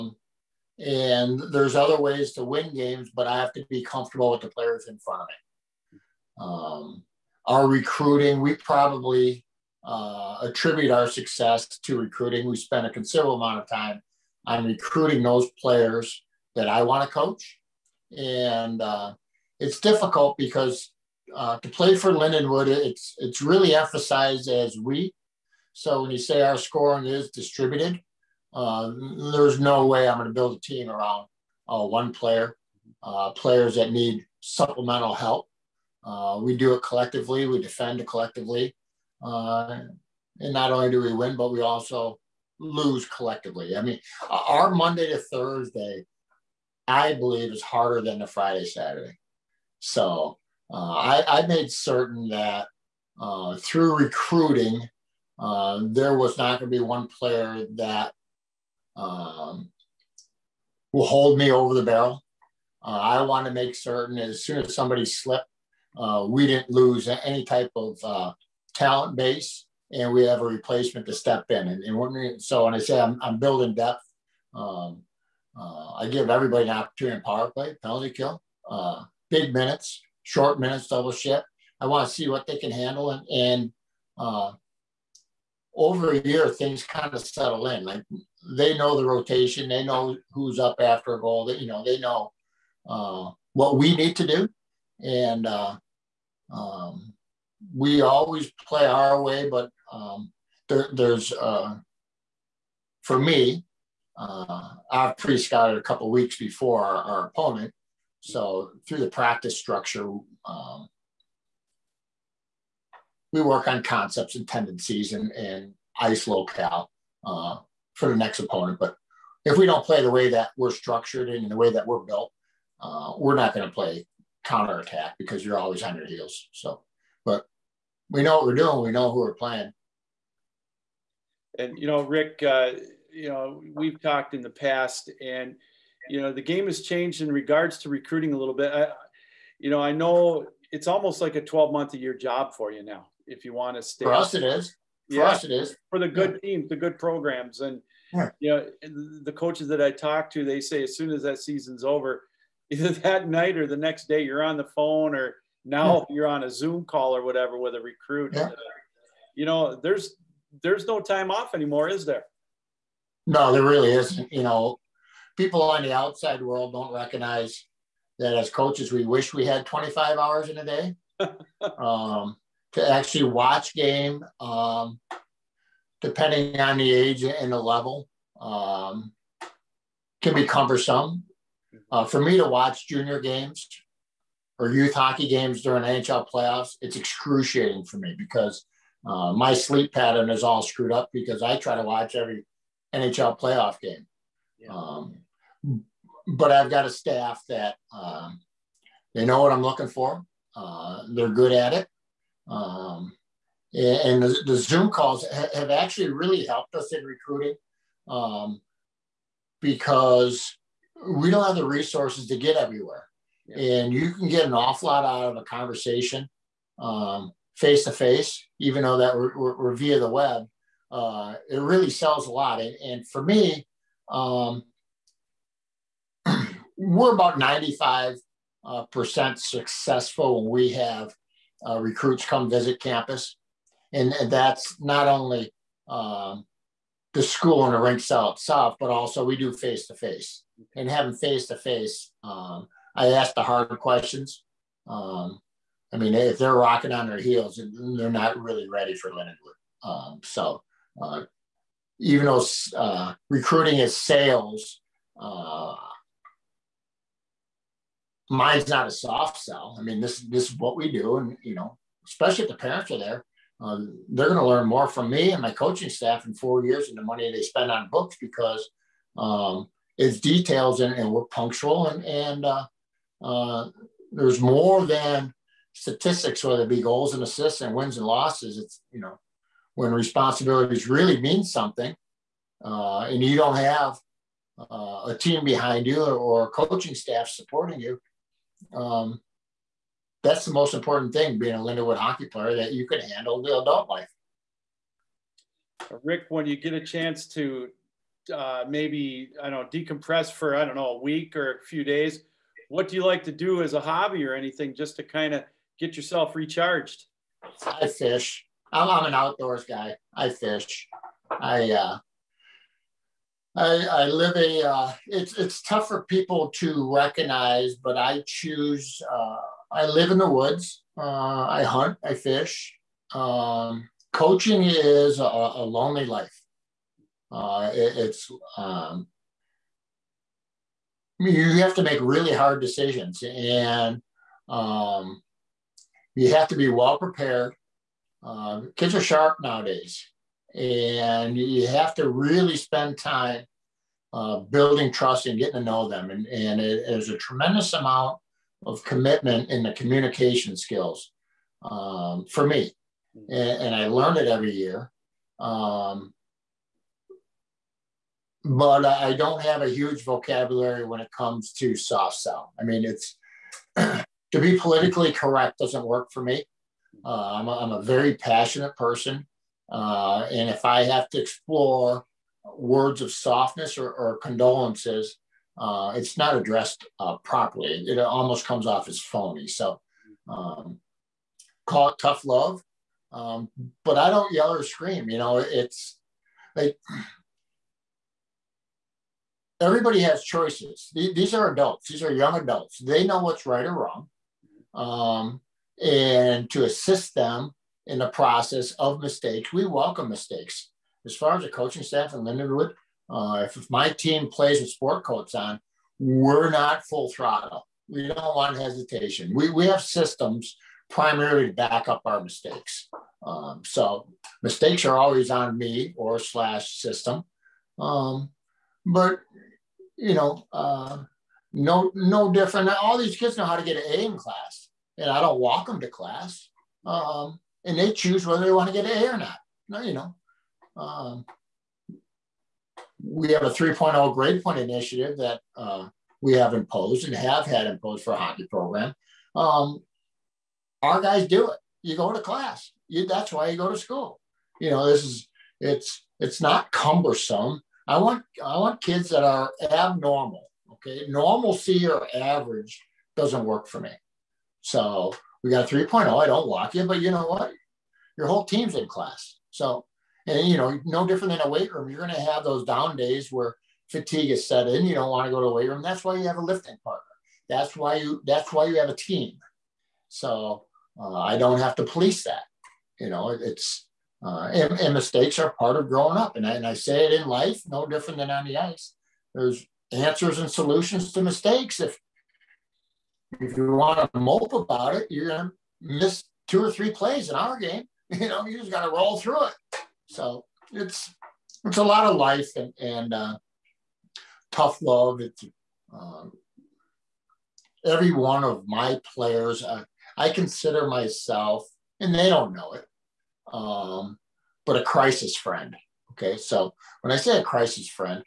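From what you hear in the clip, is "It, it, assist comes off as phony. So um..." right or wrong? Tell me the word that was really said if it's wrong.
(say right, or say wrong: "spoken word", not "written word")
wrong: "almost", not "assist".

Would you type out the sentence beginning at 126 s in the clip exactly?
So, but we know what we're doing.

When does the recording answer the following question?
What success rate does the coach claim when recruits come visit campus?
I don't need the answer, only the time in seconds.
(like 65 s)
227 s.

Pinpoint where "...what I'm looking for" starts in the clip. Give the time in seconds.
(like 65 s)
199 s.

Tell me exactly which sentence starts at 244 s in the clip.
Um, I mean, if they're rocking on their heels, they're not really ready for Lindenwood.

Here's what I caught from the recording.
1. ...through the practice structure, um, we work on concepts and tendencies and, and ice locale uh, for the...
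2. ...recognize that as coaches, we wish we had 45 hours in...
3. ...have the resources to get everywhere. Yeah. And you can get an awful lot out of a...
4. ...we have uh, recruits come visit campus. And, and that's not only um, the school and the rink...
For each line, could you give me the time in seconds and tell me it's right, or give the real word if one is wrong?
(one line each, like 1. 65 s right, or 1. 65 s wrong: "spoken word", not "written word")
1. 108 s right
2. 166 s wrong: "25", not "45"
3. 211 s right
4. 230 s right.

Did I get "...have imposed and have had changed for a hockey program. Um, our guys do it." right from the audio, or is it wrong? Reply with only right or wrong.
wrong.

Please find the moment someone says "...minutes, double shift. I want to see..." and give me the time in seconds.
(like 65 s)
80 s.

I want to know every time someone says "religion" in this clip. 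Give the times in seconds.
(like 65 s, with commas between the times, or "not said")
not said.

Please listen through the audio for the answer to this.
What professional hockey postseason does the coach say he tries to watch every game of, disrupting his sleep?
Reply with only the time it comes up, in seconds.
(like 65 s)
185 s.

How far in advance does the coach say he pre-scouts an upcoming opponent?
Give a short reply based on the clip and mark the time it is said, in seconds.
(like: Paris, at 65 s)
A couple weeks, at 105 s.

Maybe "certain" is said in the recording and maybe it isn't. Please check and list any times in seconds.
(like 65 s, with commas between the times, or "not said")
51 s, 63 s.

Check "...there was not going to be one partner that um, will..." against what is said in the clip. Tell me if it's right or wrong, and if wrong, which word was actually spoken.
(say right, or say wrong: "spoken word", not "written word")
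wrong: "player", not "partner".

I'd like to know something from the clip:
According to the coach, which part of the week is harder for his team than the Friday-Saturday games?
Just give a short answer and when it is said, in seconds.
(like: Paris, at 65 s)
Monday to Thursday, at 44 s.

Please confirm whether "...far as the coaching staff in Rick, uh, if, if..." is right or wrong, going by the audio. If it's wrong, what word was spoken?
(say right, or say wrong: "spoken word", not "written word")
wrong: "Lindenwood", not "Rick".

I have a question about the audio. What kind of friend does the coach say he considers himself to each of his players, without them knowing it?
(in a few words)
Crisis friend.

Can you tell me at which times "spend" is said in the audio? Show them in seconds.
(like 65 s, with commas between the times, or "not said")
12 s, 267 s, 342 s.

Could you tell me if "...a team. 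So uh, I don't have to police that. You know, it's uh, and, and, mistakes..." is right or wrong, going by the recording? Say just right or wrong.
right.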